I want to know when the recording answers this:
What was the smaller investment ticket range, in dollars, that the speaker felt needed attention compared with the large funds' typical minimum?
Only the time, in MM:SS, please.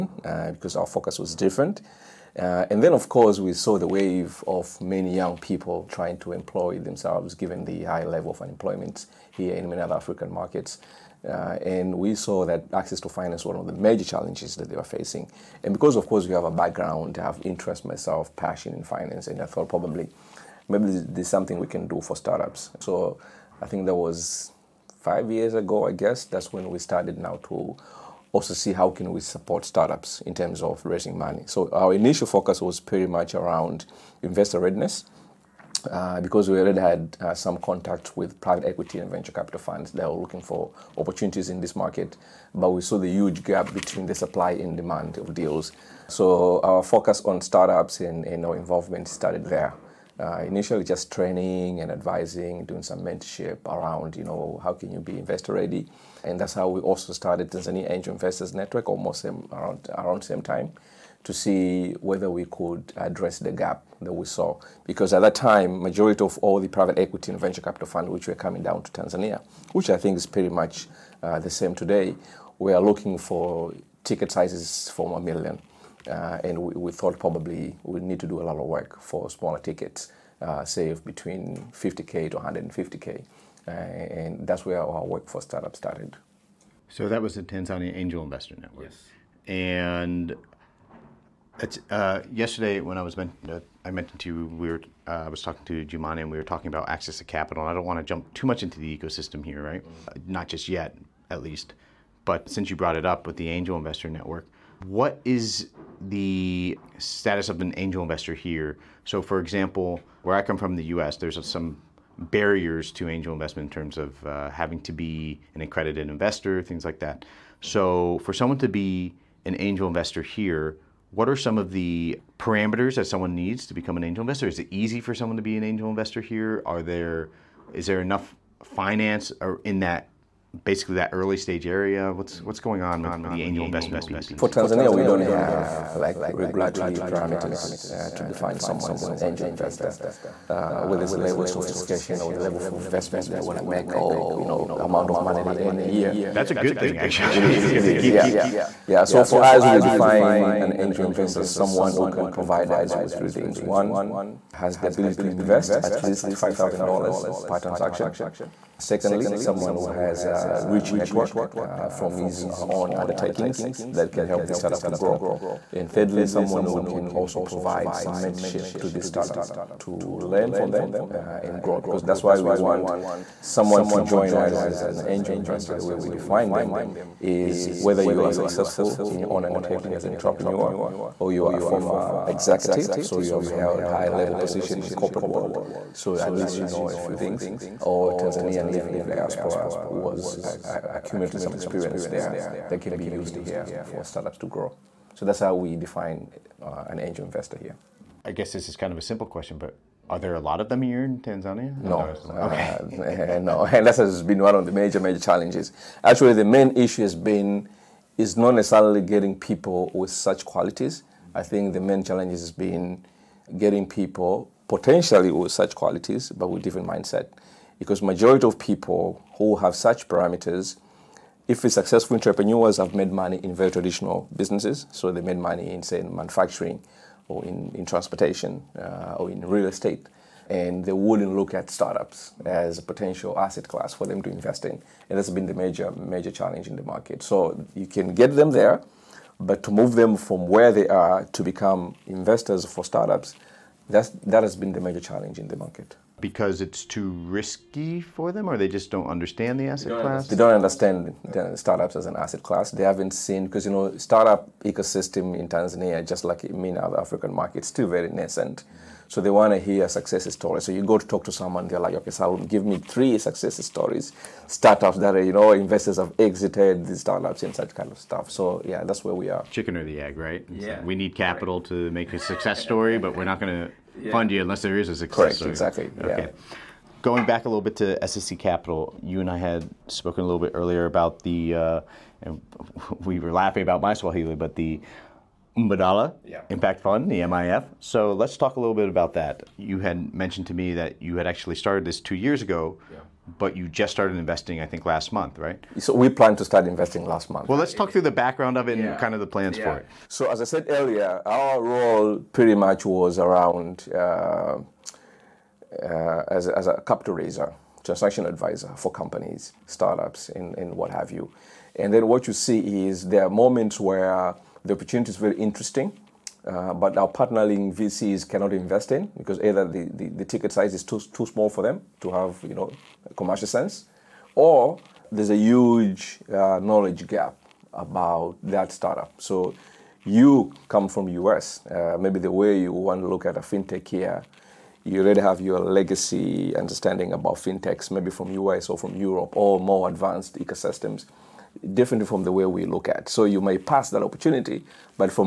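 01:21.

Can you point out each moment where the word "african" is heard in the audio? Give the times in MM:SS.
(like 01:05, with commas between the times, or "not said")
00:09, 04:17.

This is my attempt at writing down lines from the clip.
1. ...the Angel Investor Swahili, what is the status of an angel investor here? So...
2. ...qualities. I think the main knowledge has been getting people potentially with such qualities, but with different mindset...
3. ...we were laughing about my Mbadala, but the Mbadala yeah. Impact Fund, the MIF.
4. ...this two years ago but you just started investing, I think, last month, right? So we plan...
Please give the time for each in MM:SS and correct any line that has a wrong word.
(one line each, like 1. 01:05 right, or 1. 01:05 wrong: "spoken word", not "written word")
1. 01:43 wrong: "Network", not "Swahili"
2. 03:30 wrong: "challenge", not "knowledge"
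3. 04:43 wrong: "Swahili", not "Mbadala"
4. 04:51 right.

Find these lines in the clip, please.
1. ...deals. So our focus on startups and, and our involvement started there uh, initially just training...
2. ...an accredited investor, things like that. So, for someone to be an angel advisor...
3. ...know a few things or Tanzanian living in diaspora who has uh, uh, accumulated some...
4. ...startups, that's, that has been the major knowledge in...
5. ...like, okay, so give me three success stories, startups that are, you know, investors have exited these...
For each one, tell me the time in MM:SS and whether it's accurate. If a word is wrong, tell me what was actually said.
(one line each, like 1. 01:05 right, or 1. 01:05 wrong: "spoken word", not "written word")
1. 00:45 right
2. 01:55 wrong: "investor", not "advisor"
3. 03:06 right
4. 04:02 wrong: "challenge", not "knowledge"
5. 04:21 right.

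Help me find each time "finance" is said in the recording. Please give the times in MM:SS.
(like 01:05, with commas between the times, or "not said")
00:13, 00:18, 02:08.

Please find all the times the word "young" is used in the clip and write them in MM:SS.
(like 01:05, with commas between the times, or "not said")
00:05.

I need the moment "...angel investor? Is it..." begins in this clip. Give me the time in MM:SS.
02:04.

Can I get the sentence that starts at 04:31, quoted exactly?
to make a success story, but we're not going to yeah.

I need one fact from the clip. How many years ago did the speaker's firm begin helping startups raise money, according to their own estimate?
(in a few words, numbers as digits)
5.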